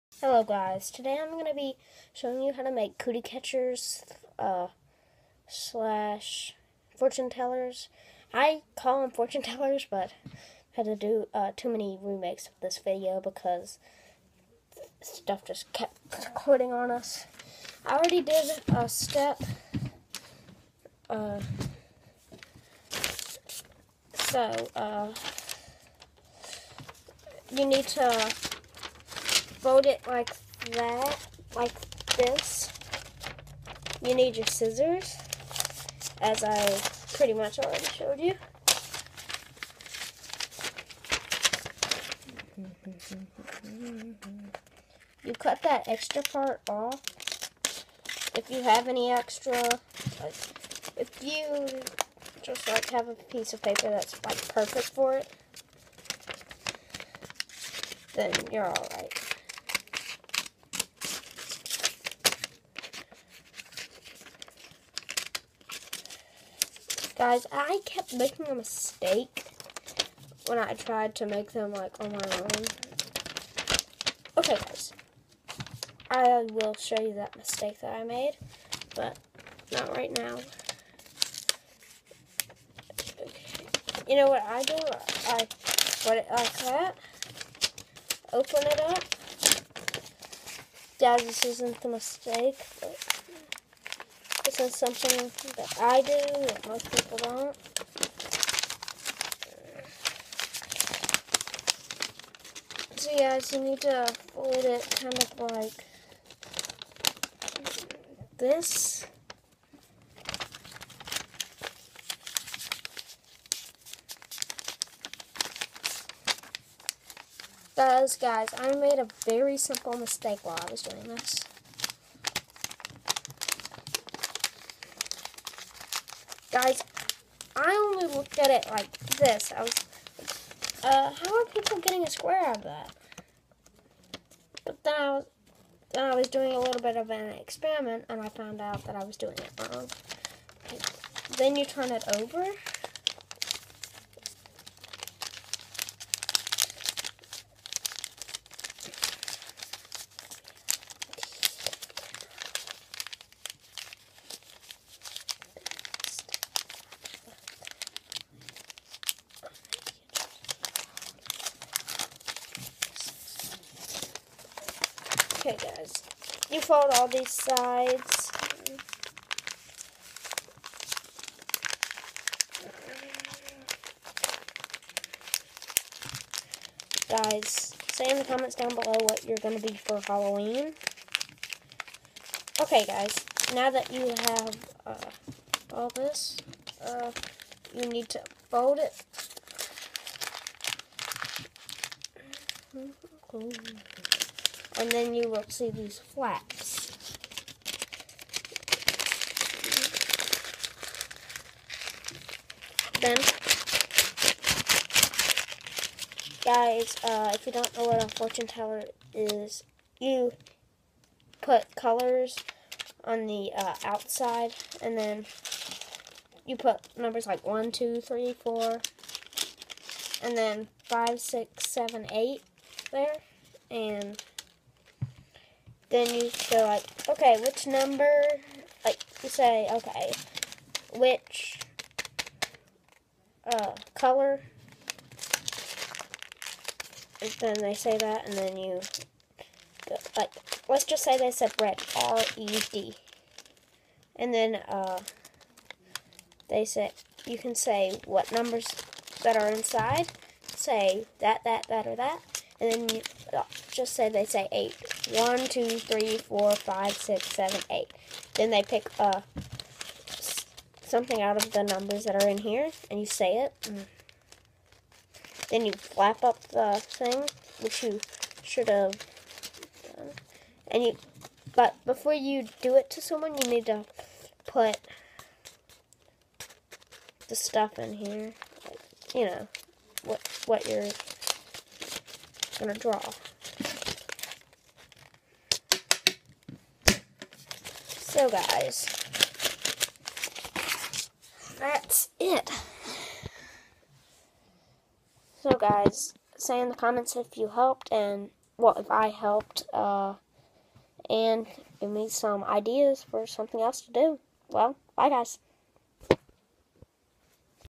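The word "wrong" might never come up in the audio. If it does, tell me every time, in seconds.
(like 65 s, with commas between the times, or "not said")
139 s.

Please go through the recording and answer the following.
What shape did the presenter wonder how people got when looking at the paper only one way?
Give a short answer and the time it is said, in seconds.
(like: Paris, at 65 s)
square, at 132 s.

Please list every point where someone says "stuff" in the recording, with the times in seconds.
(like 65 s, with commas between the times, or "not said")
15 s, 277 s.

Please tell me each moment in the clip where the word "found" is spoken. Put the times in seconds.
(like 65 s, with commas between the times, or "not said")
138 s.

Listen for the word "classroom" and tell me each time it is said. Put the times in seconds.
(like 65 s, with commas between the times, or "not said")
not said.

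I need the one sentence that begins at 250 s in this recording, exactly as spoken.
Say that, that, that, or that and then you, uh, just say they say eight.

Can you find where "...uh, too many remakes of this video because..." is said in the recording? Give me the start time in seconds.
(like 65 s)
11 s.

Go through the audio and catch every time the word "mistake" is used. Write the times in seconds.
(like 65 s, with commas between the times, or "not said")
68 s, 77 s, 91 s, 119 s.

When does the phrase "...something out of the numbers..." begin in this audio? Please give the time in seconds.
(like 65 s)
260 s.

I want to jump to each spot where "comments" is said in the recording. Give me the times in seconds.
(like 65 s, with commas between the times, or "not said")
178 s, 296 s.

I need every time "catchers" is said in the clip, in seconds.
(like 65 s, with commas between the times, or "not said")
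3 s.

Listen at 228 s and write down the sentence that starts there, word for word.
Like you say, okay, which uh, color?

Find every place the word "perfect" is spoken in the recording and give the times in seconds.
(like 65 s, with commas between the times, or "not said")
54 s.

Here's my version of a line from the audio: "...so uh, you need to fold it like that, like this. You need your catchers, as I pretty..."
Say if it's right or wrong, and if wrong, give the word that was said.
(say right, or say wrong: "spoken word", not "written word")
wrong: "scissors", not "catchers".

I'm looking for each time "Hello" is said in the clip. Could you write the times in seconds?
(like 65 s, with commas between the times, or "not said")
0 s.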